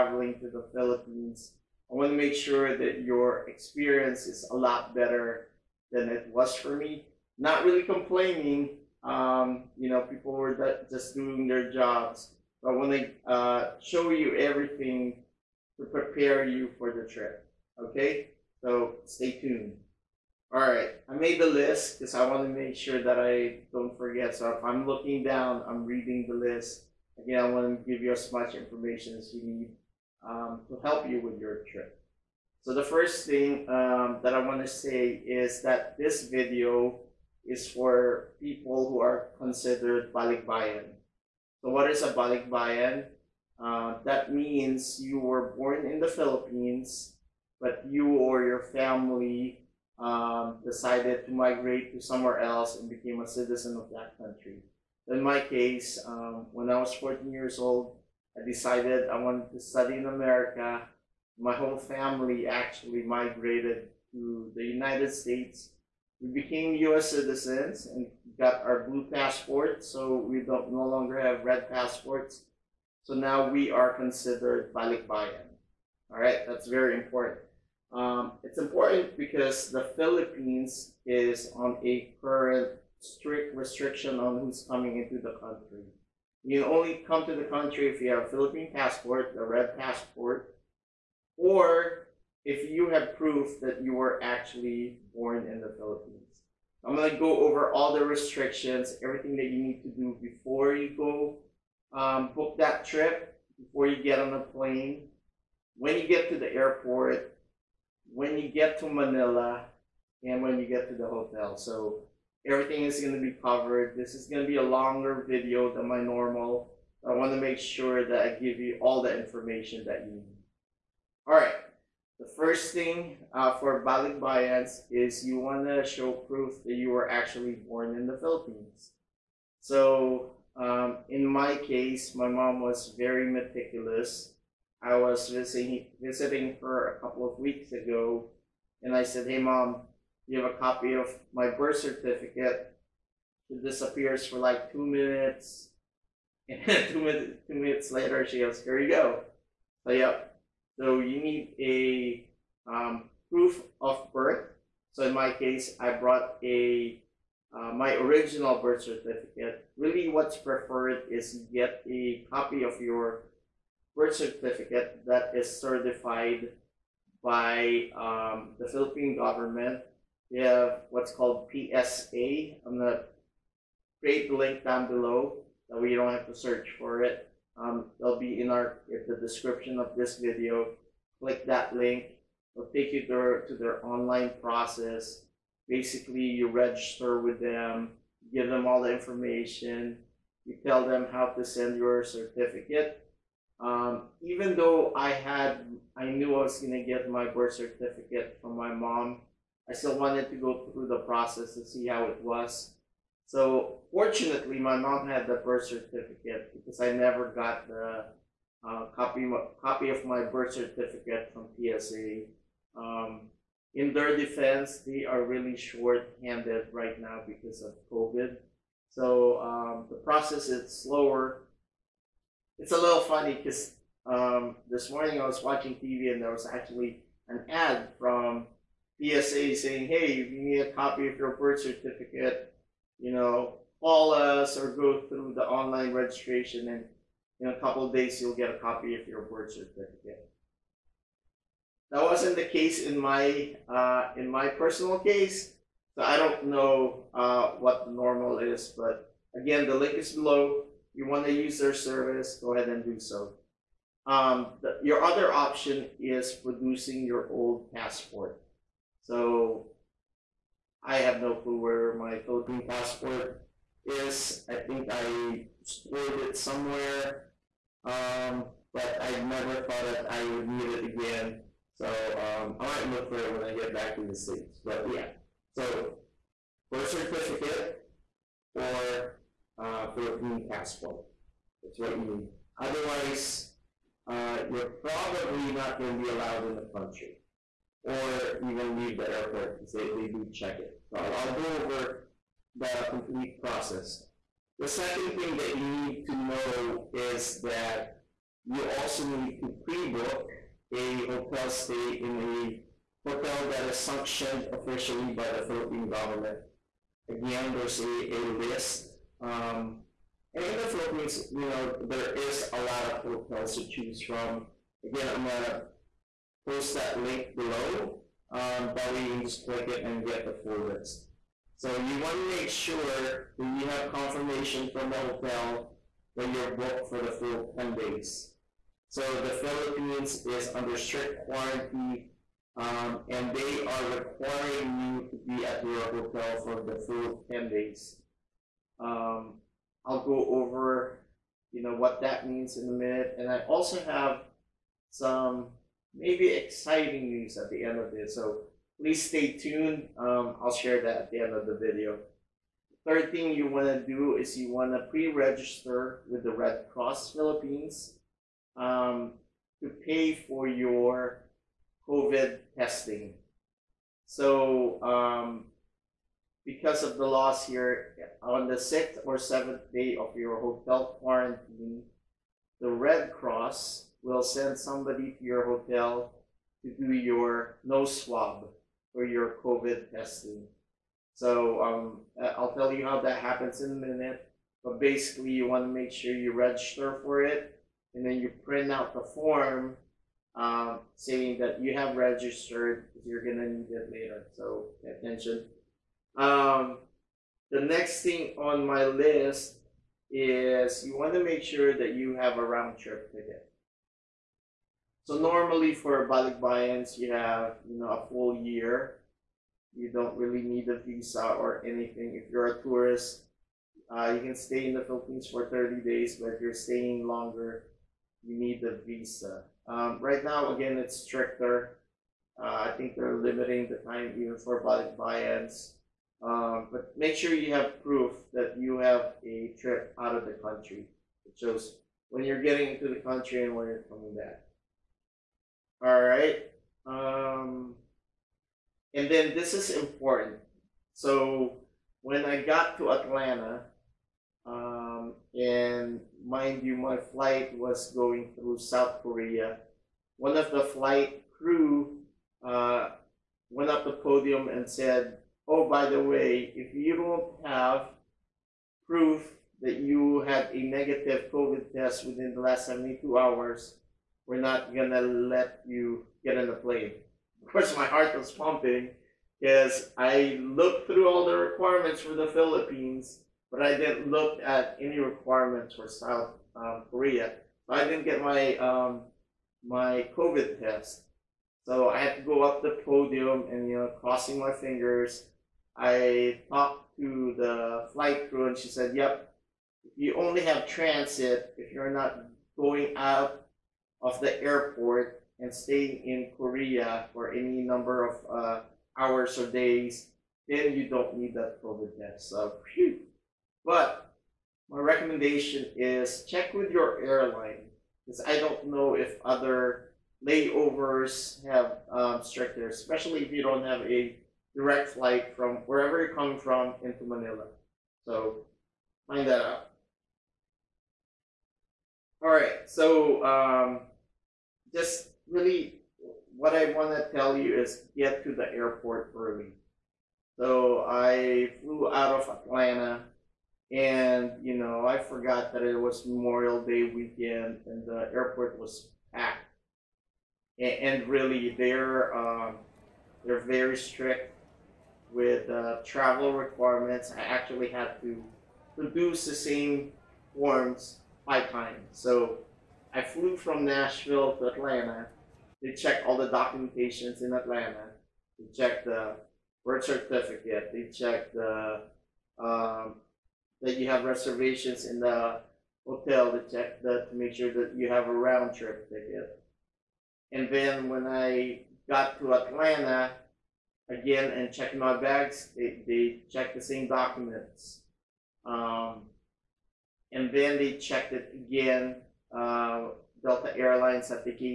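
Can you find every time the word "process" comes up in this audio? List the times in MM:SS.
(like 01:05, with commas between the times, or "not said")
03:04, 03:20, 03:39, 04:53.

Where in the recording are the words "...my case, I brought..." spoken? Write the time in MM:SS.
02:35.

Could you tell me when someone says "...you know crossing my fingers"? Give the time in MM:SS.
08:03.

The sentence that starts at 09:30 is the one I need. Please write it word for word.
And then when I got to Atlanta again and checked my bags, they, they checked the same documents.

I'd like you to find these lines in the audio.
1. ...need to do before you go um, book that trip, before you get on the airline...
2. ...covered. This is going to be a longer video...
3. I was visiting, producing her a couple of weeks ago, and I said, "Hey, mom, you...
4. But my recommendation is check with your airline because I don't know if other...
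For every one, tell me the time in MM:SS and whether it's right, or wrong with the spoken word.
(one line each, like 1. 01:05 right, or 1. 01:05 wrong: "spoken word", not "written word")
1. 01:39 wrong: "plane", not "airline"
2. 01:53 right
3. 02:14 wrong: "visiting", not "producing"
4. 08:23 right.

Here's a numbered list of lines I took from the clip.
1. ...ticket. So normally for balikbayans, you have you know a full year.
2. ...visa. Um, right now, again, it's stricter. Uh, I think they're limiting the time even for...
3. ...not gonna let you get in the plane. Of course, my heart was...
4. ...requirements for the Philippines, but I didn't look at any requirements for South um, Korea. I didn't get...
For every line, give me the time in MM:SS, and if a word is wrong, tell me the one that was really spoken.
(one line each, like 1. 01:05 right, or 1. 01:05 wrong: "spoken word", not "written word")
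1. 06:43 right
2. 06:58 right
3. 07:44 right
4. 07:51 right.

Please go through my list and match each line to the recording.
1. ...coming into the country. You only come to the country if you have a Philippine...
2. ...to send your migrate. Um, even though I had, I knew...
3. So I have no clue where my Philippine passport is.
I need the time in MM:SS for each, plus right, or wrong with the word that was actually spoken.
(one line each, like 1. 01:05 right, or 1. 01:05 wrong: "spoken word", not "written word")
1. 01:24 right
2. 03:11 wrong: "certificate", not "migrate"
3. 04:19 right.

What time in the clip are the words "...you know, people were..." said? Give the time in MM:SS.
00:09.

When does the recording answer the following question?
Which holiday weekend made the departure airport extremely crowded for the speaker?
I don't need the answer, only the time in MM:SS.
08:56.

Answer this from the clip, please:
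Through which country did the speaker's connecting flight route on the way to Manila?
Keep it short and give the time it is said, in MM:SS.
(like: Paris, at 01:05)
South Korea, at 07:28.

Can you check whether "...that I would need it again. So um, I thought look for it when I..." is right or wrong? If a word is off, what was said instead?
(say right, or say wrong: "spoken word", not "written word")
wrong: "might", not "thought".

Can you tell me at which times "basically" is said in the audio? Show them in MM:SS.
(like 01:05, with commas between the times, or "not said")
03:05, 06:24.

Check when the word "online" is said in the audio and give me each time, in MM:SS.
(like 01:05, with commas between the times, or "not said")
03:03, 03:55.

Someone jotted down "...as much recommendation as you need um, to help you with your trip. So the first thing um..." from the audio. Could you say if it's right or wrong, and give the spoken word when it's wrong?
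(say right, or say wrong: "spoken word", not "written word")
wrong: "information", not "recommendation".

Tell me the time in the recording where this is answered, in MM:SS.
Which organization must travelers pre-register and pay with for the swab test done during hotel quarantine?
05:56.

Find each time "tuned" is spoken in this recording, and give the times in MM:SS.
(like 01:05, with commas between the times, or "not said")
00:19, 05:49.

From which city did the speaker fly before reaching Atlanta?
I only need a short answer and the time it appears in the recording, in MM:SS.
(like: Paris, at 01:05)
Nashville, at 09:13.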